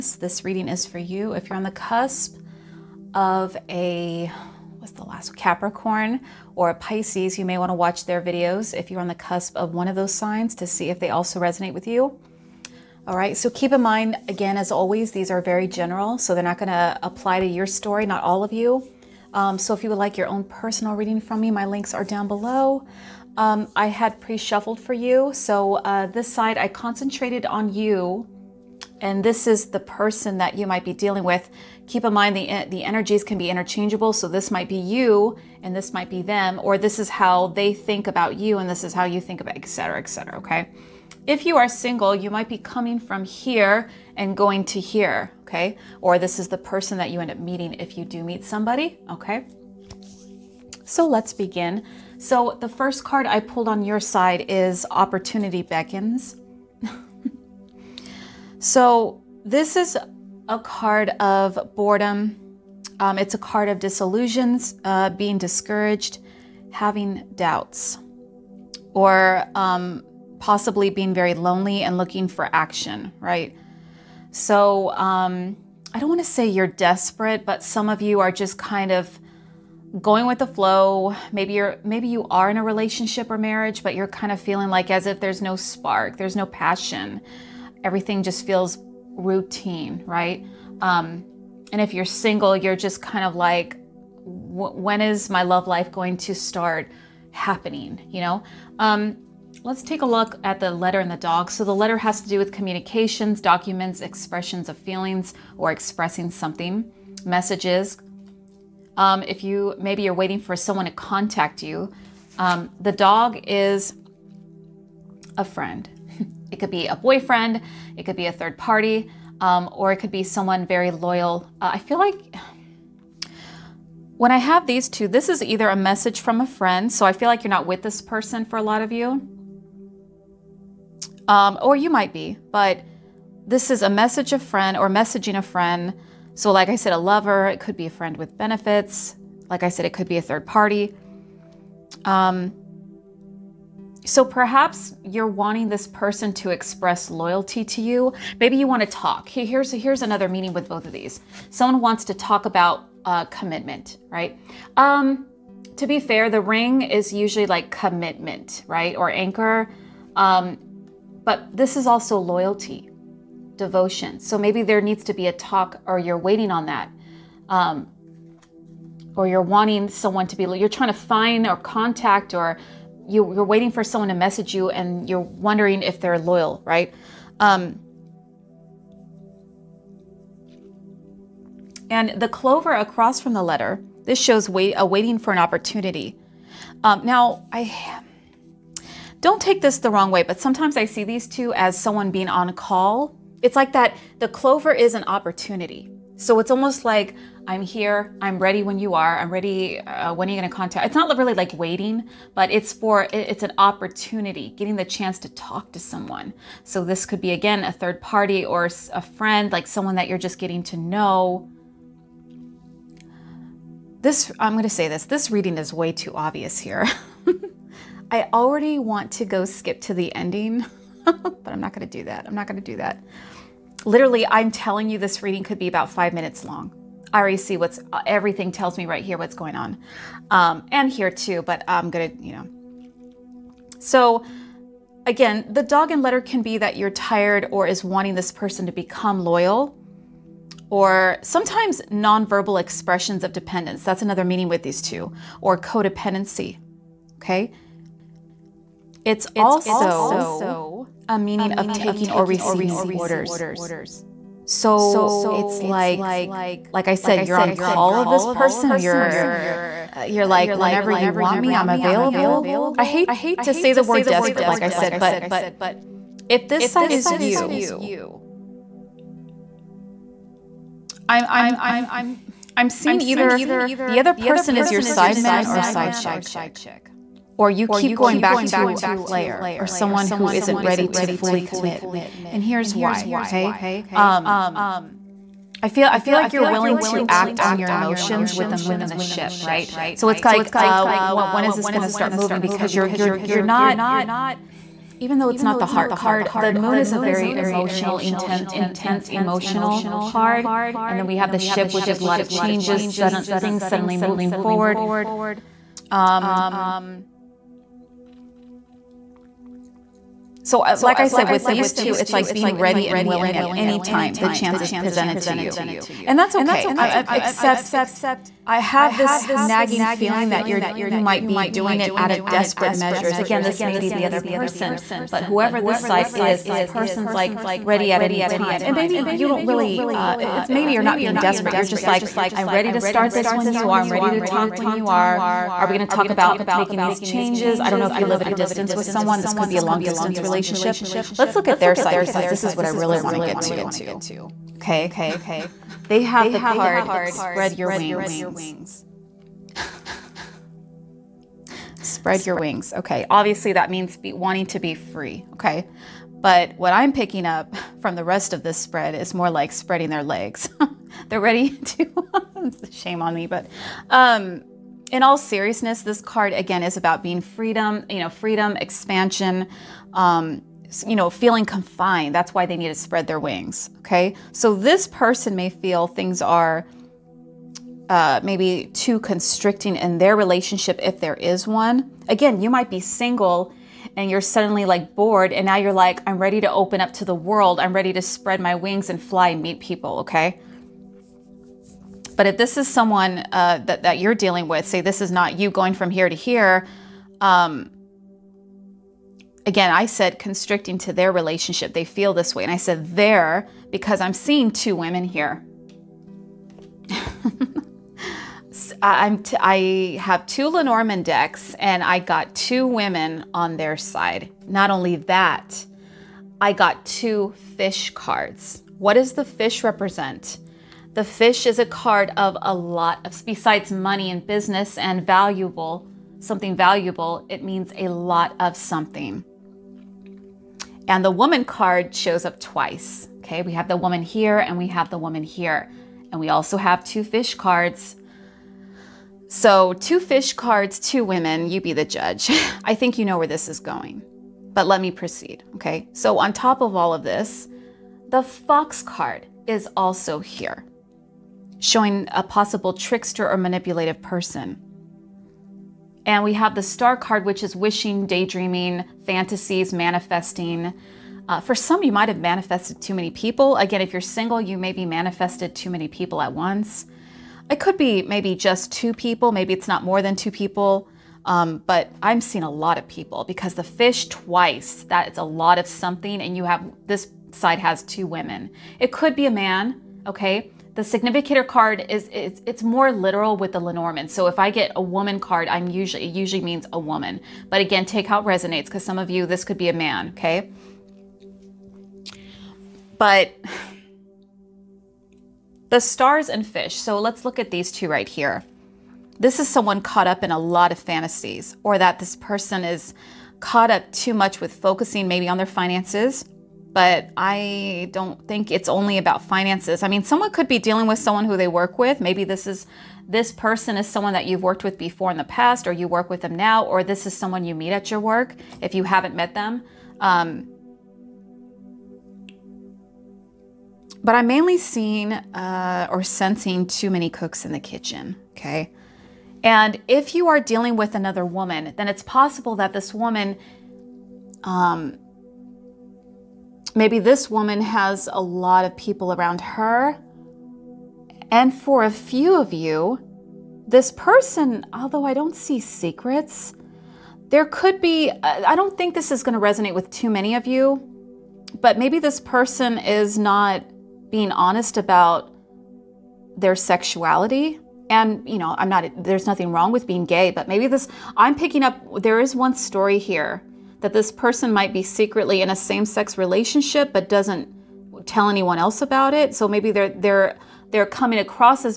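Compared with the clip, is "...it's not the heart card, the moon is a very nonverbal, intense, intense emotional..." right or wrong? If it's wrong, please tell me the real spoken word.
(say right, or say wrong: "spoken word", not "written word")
wrong: "emotional", not "nonverbal".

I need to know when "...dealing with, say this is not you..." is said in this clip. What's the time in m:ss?
6:34.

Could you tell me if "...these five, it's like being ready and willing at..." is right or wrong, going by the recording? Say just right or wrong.
wrong.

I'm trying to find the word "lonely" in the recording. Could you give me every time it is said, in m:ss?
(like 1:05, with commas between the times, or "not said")
1:11.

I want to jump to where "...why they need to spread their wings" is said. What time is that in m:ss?
6:12.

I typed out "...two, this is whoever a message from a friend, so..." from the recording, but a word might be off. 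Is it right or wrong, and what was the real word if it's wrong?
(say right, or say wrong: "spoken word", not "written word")
wrong: "either", not "whoever".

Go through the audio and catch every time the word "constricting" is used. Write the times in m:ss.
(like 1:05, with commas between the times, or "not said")
6:18, 6:40.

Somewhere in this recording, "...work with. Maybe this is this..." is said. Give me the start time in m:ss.
8:31.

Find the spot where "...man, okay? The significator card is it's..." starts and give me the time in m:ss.
7:59.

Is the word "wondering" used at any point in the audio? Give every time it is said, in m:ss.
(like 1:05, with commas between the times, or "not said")
2:55.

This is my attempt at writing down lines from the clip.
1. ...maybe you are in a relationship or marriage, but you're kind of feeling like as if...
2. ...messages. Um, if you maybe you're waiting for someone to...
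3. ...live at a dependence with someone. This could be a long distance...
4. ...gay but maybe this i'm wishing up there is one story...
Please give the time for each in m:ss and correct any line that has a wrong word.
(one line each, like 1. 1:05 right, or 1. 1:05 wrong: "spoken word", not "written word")
1. 1:21 right
2. 1:47 right
3. 5:38 wrong: "distance", not "dependence"
4. 9:20 wrong: "picking", not "wishing".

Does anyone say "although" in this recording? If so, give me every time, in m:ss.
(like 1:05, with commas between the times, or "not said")
9:04.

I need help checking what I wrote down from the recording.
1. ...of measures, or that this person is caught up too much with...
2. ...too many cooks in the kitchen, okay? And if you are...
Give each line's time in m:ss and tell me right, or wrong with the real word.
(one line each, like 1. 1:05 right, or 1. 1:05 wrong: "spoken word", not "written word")
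1. 8:20 wrong: "fantasies", not "measures"
2. 8:46 right.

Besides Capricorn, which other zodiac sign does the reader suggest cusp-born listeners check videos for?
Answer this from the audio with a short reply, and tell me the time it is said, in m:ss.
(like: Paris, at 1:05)
Pisces, at 0:06.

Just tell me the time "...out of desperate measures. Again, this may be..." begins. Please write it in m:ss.
5:21.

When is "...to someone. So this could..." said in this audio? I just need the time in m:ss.
3:25.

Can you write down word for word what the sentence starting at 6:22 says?
Again, you might be single and you're suddenly like bored and now you're like, I'm ready to open up to the world.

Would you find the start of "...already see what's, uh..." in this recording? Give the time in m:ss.
3:47.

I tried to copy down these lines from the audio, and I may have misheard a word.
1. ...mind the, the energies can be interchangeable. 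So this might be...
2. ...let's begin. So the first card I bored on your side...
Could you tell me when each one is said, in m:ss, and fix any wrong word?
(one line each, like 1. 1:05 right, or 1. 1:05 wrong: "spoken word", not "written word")
1. 0:32 right
2. 0:51 wrong: "pulled", not "bored".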